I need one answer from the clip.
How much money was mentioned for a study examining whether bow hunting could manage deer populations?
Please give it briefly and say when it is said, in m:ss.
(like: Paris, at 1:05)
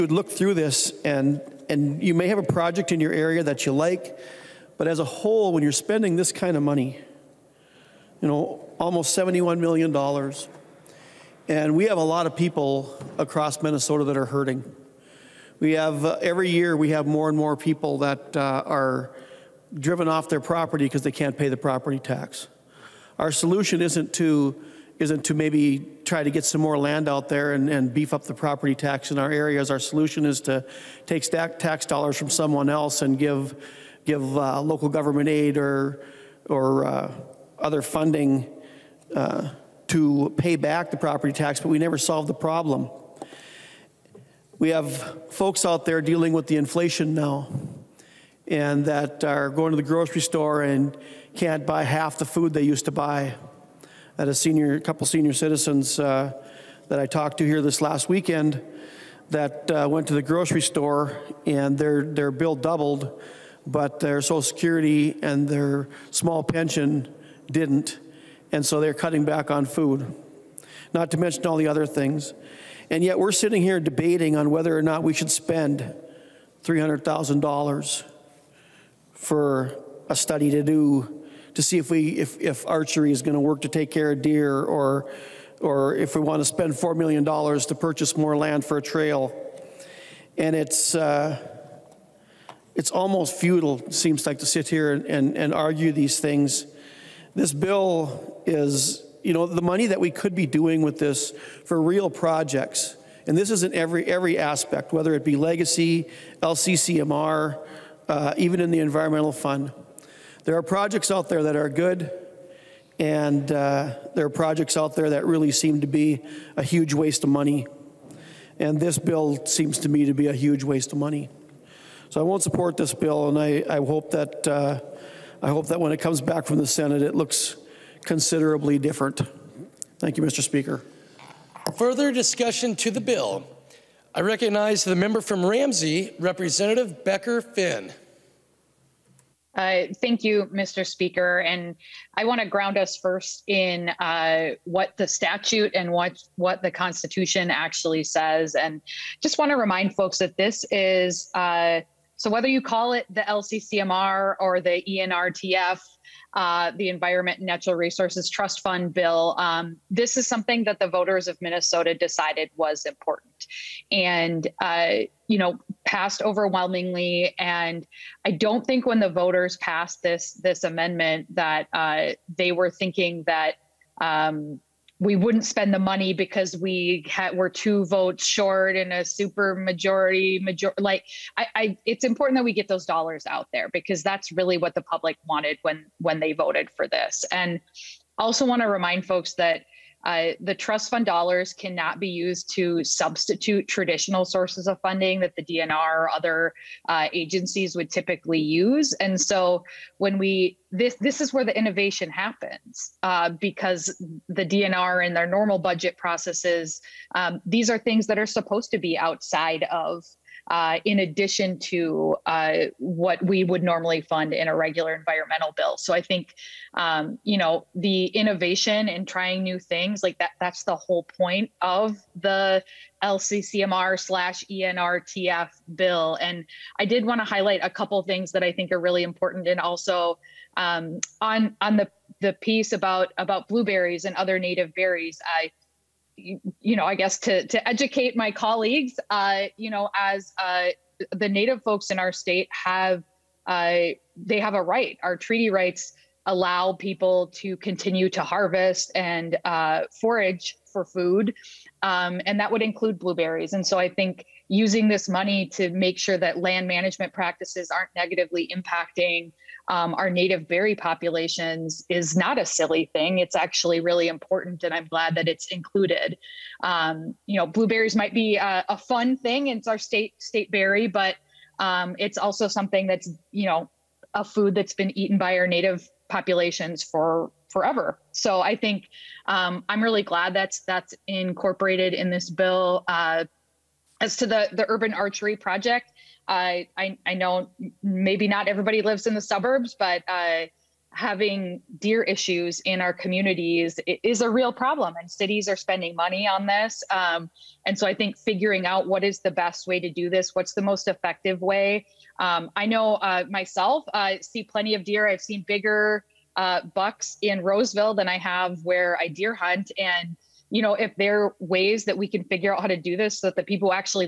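$300,000, at 1:16.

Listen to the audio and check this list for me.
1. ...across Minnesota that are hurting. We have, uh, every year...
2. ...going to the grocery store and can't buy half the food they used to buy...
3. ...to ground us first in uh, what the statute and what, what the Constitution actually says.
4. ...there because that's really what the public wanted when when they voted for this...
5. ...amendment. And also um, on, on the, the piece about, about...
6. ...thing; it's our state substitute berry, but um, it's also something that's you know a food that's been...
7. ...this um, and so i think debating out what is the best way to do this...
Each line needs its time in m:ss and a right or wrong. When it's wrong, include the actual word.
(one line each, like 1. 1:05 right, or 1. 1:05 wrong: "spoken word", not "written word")
1. 0:13 right
2. 0:49 right
3. 2:22 right
4. 3:03 right
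5. 3:49 wrong: "important", not "amendment"
6. 4:29 wrong: "state", not "substitute"
7. 4:56 wrong: "figuring", not "debating".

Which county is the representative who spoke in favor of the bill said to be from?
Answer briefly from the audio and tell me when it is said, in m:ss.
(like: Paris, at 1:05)
Ramsey, at 2:15.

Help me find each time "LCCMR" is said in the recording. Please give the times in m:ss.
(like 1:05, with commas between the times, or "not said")
1:46, 2:33, 3:43.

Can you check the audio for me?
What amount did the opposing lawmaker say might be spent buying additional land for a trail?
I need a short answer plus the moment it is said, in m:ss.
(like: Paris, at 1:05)
4 million dollars, at 1:26.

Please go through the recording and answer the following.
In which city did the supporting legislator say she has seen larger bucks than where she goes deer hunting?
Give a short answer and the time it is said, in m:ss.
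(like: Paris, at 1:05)
Roseville, at 5:07.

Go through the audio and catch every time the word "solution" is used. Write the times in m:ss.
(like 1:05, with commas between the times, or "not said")
0:23, 0:29.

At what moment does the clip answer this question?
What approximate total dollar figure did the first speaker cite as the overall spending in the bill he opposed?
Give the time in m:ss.
0:09.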